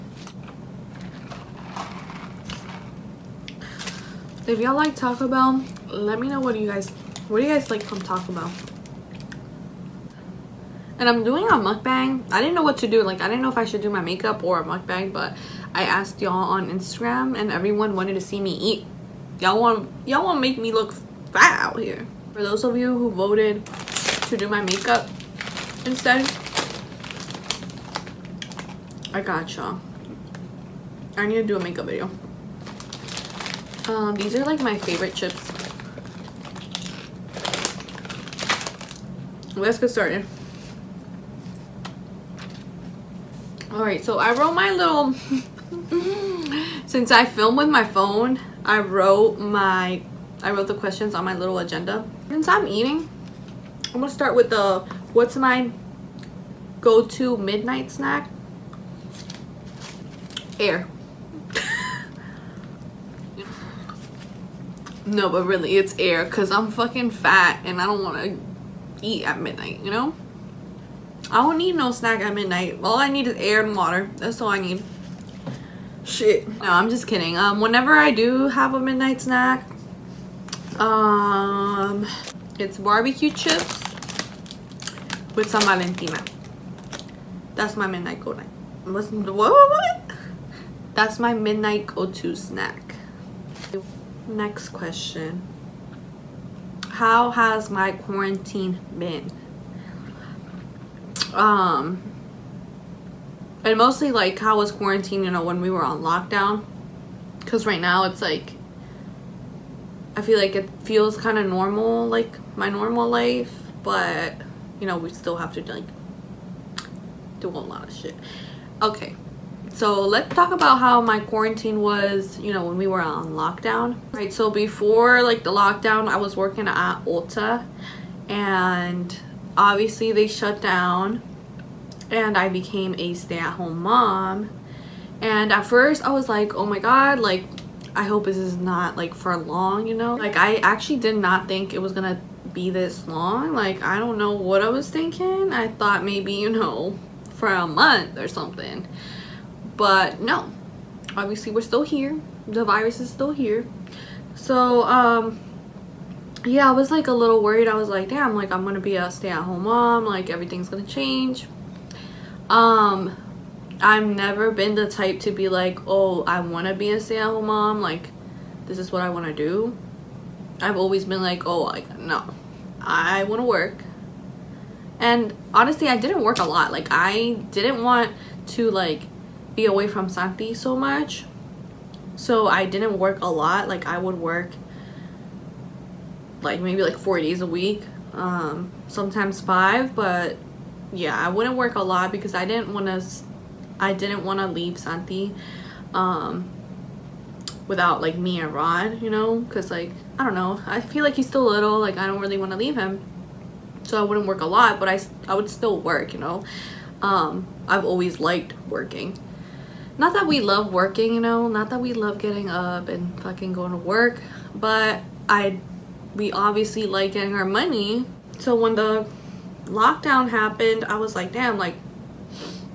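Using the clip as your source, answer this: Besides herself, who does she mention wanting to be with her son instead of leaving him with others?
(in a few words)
Rod.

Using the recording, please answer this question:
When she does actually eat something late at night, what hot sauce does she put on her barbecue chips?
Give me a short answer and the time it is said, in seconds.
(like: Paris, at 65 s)
Valentina, at 85 s.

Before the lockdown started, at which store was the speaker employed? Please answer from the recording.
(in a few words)
Ulta.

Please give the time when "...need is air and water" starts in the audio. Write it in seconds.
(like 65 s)
73 s.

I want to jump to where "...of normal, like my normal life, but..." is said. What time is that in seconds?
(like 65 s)
111 s.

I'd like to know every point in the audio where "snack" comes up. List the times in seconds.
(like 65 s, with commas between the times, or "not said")
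57 s, 71 s, 79 s, 92 s.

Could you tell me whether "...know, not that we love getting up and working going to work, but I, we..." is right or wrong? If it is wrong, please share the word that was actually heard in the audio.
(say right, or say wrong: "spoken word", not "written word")
wrong: "fucking", not "working".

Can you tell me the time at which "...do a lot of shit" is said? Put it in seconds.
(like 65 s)
117 s.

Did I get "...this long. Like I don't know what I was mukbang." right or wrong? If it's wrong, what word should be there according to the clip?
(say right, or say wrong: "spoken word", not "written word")
wrong: "thinking", not "mukbang".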